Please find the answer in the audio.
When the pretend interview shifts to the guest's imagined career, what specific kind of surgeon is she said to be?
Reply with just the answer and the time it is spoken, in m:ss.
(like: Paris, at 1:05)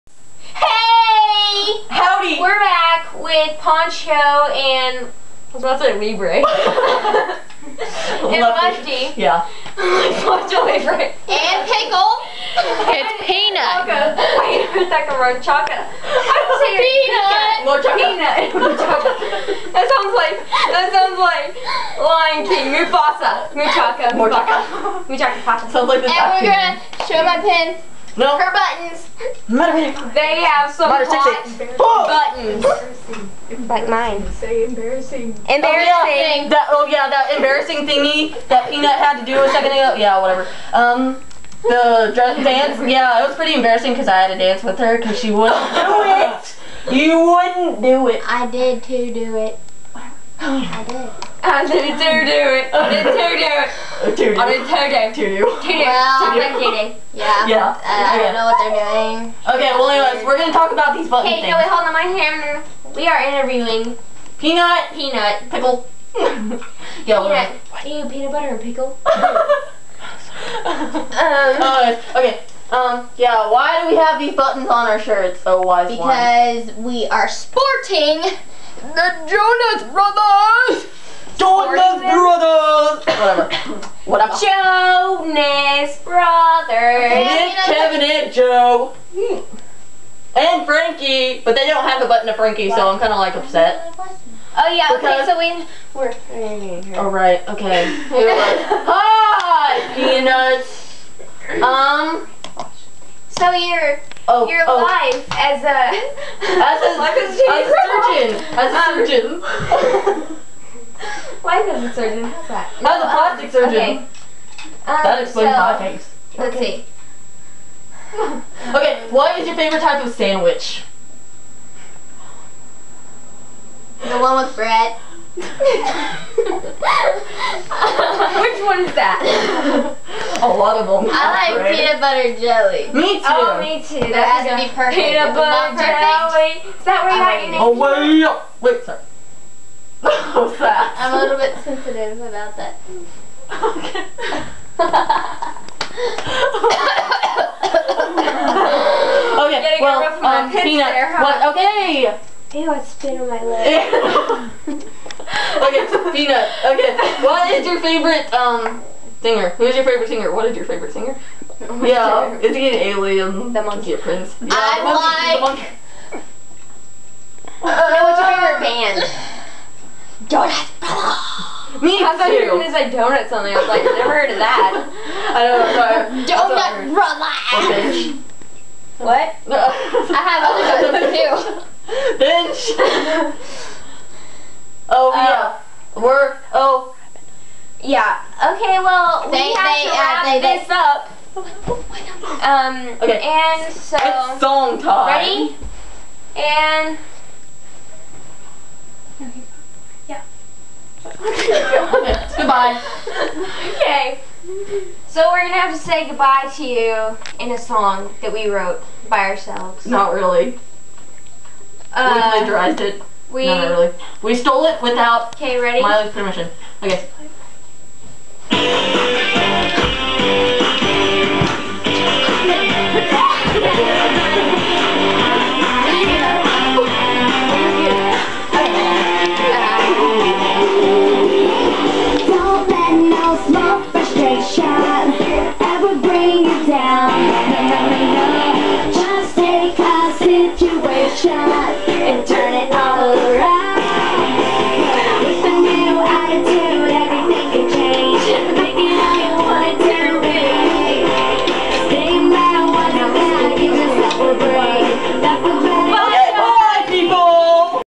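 plastic surgeon, at 1:52.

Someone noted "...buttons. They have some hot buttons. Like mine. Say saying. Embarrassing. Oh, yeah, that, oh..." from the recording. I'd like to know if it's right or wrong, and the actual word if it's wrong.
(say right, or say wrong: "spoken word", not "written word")
wrong: "embarrassing", not "saying".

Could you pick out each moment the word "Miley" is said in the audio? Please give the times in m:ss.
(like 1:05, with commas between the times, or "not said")
3:35.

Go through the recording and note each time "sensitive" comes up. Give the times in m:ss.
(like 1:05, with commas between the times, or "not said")
2:21.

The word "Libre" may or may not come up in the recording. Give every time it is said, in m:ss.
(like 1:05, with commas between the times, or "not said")
0:05, 0:10.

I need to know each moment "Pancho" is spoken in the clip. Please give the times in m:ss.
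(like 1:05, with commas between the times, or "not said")
0:03, 0:10.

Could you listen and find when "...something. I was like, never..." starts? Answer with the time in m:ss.
2:53.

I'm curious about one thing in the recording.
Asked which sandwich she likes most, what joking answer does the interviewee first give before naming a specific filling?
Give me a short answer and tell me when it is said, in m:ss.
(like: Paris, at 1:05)
The one with bread, at 2:04.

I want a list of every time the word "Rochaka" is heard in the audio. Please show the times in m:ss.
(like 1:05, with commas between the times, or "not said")
0:17.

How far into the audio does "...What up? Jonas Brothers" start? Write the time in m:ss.
1:24.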